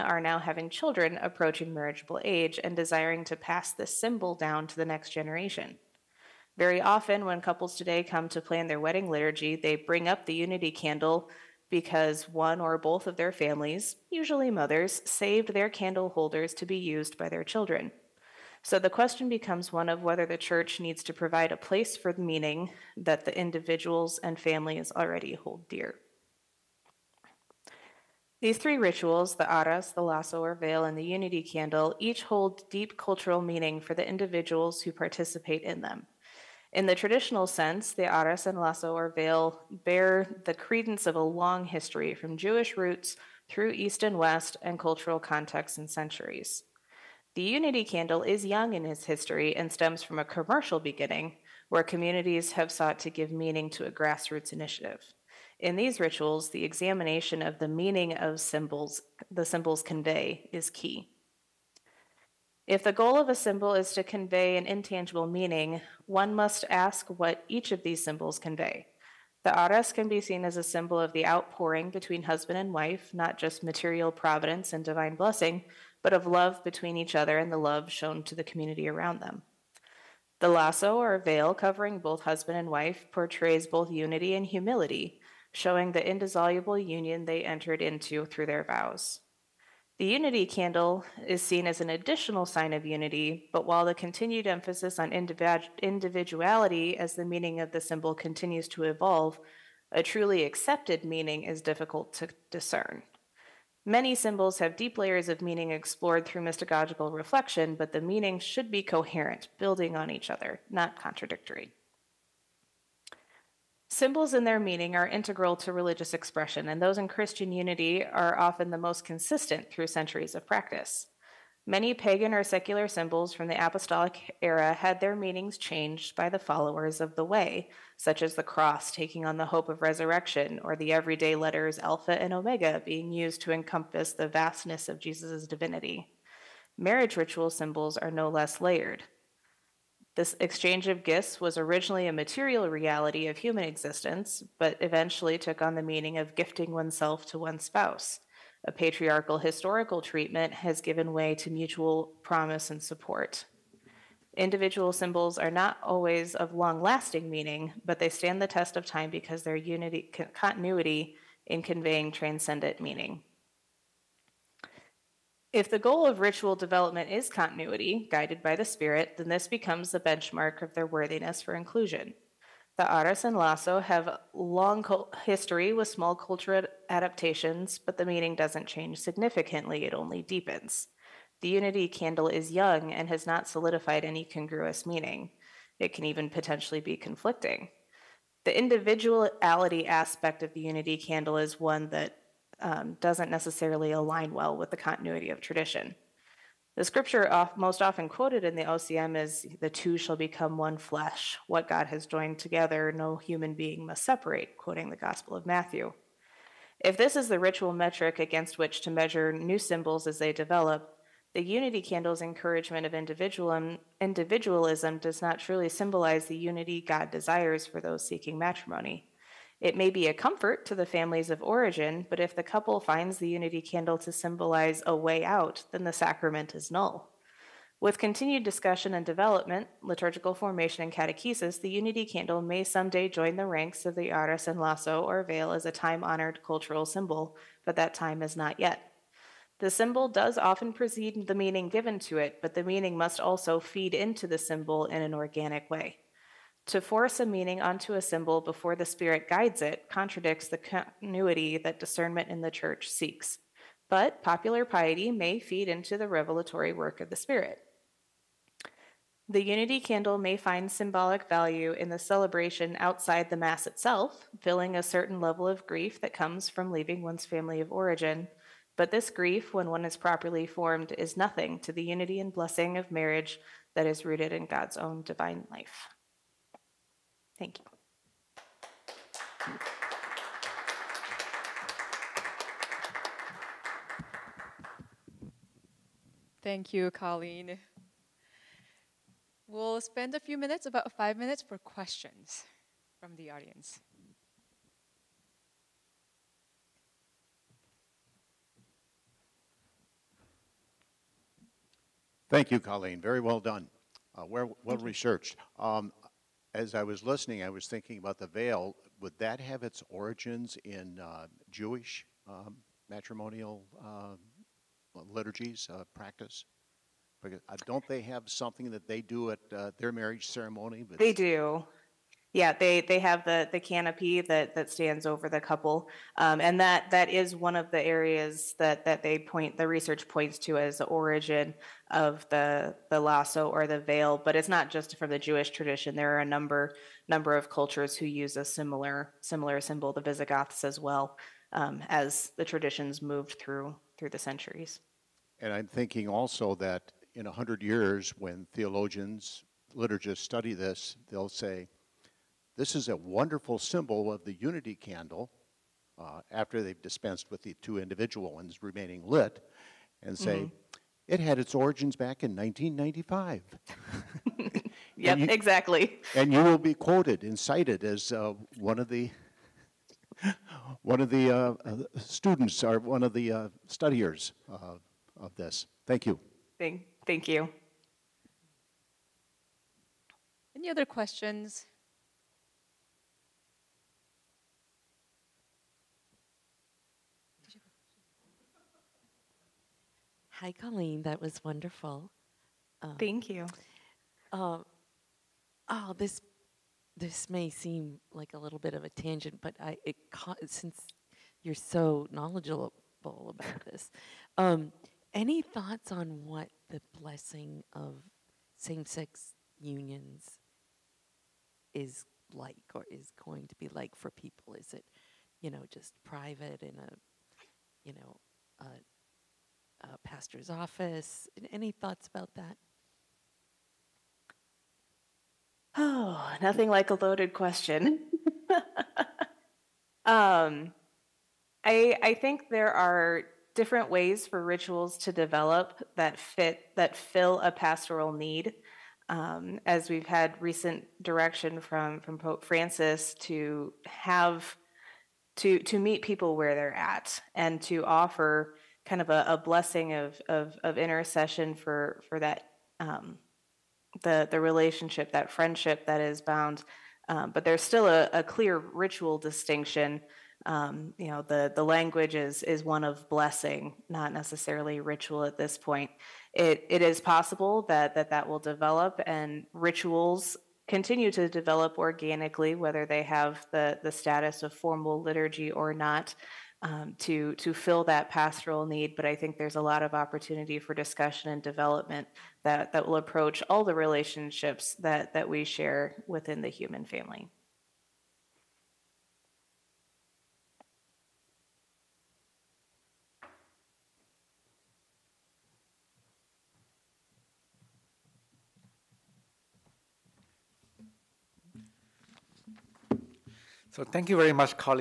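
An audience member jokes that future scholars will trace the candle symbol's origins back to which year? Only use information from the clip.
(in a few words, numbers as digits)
1995.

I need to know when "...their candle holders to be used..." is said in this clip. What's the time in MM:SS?
00:15.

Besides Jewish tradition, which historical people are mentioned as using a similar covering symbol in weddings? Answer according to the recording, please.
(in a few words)
Visigoths.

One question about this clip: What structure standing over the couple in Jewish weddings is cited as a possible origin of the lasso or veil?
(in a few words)
the canopy.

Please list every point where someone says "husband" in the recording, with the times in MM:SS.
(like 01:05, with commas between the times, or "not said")
01:12, 01:22.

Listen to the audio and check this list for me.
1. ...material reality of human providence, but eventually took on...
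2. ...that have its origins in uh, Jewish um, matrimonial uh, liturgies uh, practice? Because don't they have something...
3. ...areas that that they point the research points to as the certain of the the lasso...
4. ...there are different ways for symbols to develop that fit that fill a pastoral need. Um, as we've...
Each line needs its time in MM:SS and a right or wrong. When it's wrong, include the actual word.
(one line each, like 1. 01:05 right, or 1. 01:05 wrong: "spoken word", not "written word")
1. 02:22 wrong: "existence", not "providence"
2. 05:09 right
3. 05:27 wrong: "origin", not "certain"
4. 07:12 wrong: "rituals", not "symbols".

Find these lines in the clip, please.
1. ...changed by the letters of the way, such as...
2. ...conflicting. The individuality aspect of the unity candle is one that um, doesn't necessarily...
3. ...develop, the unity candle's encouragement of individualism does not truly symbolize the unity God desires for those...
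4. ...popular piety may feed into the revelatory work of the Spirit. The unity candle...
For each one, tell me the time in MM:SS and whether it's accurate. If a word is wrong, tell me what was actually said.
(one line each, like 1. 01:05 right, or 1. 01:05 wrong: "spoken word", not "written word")
1. 02:05 wrong: "followers", not "letters"
2. 03:06 right
3. 03:30 right
4. 04:14 right.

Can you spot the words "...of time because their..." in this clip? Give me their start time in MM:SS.
02:38.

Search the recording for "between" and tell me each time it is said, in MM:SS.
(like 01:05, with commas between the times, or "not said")
01:11, 01:16.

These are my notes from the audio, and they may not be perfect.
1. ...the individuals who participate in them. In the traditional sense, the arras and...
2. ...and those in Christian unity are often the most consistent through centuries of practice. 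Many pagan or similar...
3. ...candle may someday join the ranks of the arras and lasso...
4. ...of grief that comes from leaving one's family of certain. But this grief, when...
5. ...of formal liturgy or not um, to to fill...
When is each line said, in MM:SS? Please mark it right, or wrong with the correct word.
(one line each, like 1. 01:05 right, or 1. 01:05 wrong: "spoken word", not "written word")
1. 00:33 right
2. 01:56 wrong: "secular", not "similar"
3. 03:52 right
4. 04:25 wrong: "origin", not "certain"
5. 07:54 right.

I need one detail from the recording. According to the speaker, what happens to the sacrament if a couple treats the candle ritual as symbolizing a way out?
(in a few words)
null.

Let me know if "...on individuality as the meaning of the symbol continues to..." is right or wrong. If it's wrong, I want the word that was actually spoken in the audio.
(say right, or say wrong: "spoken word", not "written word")
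right.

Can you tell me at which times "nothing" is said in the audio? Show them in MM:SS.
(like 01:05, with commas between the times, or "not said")
04:31, 07:06.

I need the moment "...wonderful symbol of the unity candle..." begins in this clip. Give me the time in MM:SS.
05:52.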